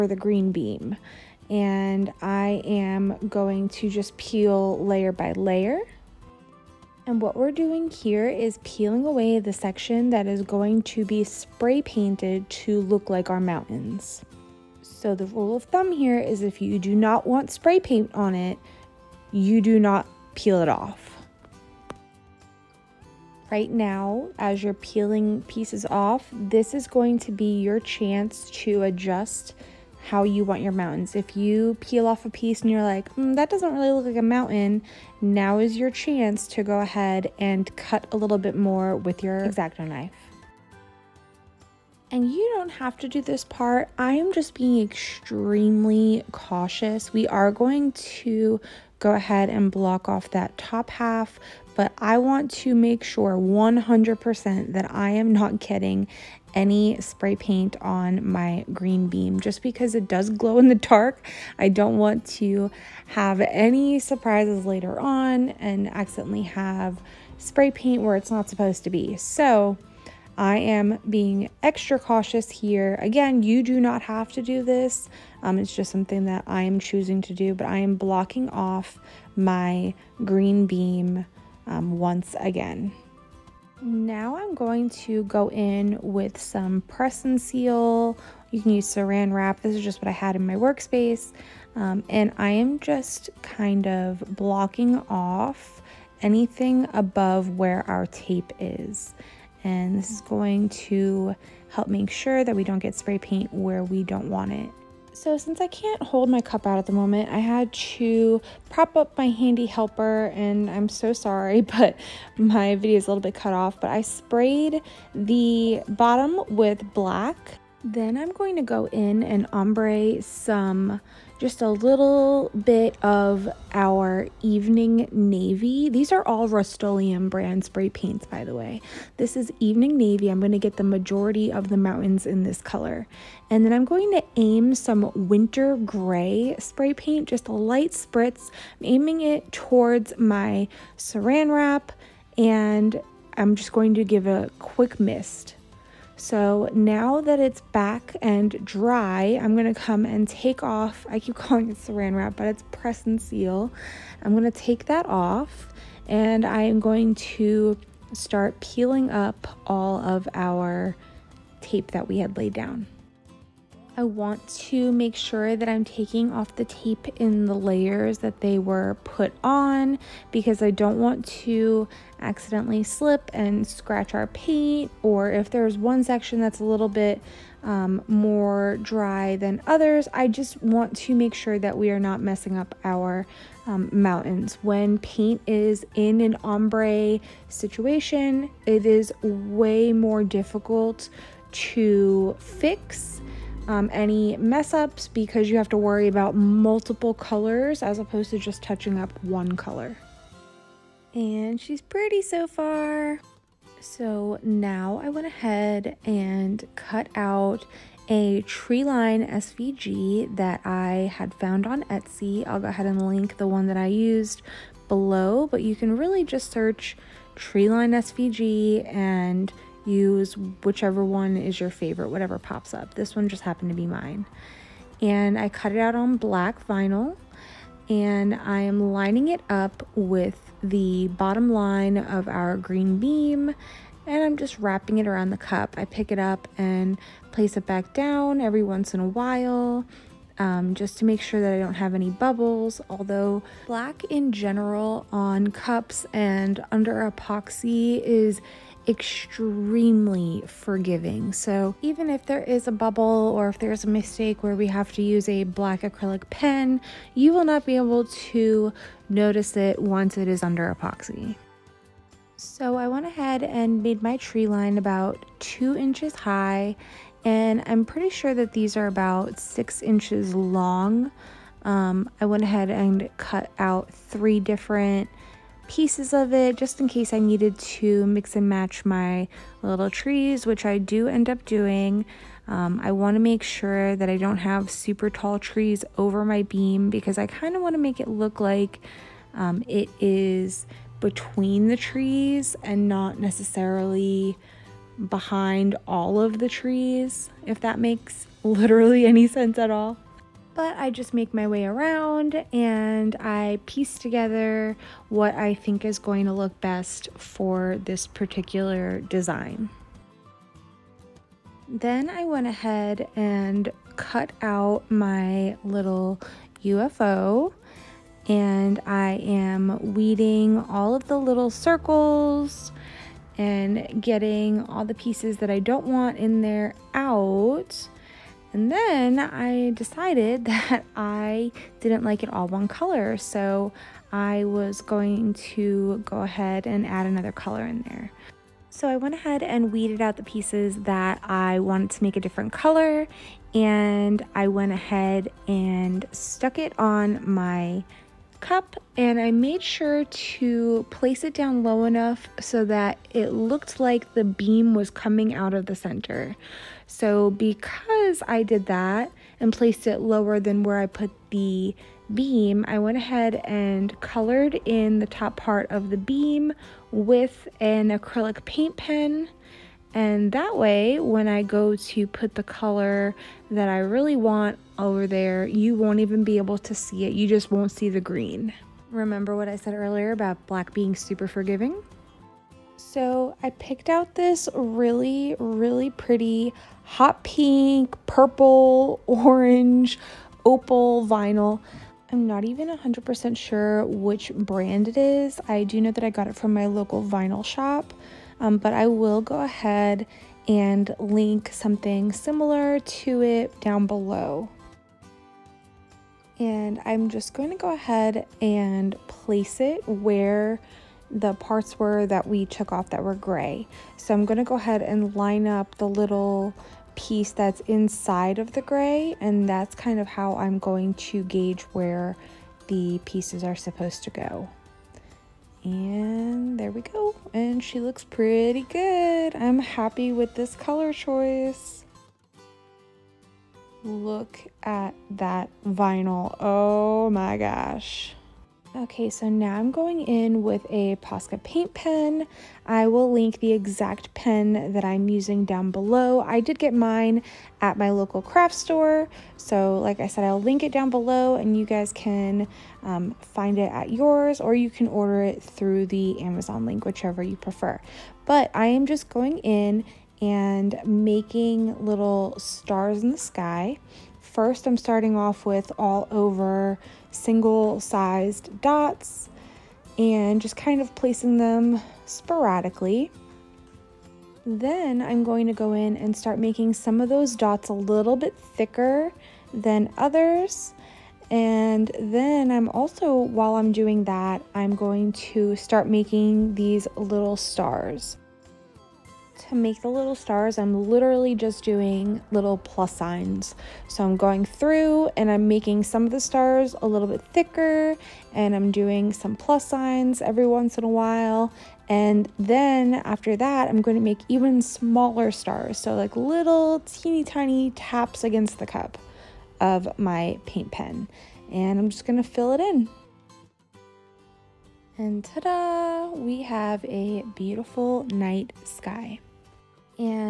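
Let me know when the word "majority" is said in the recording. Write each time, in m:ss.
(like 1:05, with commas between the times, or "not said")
2:10.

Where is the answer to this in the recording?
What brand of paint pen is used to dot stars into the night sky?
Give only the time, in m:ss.
7:20.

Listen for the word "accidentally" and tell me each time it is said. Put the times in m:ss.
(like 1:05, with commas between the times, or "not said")
1:05, 2:52.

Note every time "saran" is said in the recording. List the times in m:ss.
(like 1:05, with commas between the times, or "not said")
1:28, 2:20, 2:31.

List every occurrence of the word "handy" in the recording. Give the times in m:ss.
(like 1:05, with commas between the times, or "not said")
1:49.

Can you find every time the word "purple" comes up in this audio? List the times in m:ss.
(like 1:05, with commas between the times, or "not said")
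6:28.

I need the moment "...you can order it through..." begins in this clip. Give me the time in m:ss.
7:34.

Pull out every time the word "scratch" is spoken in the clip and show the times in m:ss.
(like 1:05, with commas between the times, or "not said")
2:53.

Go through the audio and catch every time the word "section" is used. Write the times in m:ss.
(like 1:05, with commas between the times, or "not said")
0:09, 2:56.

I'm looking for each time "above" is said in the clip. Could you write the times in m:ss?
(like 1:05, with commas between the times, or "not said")
1:36.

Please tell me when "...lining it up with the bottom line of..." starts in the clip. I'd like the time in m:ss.
3:48.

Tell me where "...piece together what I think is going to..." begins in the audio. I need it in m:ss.
5:03.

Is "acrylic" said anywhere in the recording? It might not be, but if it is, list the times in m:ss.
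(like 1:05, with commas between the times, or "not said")
4:15, 6:07.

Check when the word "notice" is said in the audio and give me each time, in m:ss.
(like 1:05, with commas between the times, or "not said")
4:19.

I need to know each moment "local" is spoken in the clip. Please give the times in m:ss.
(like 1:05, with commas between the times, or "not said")
6:36, 7:27.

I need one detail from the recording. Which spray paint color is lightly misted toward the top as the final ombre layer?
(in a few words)
Winter Gray.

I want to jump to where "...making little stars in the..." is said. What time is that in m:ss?
7:40.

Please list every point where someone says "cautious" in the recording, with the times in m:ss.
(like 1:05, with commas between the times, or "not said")
0:46, 1:11.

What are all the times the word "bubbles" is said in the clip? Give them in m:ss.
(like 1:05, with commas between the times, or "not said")
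4:02, 4:12.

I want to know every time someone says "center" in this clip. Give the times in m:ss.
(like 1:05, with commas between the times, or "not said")
5:55.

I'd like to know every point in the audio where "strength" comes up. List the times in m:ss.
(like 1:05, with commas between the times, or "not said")
not said.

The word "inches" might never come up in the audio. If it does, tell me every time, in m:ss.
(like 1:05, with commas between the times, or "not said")
4:25, 4:29.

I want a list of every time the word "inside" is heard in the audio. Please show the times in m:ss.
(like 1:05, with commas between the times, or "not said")
6:57.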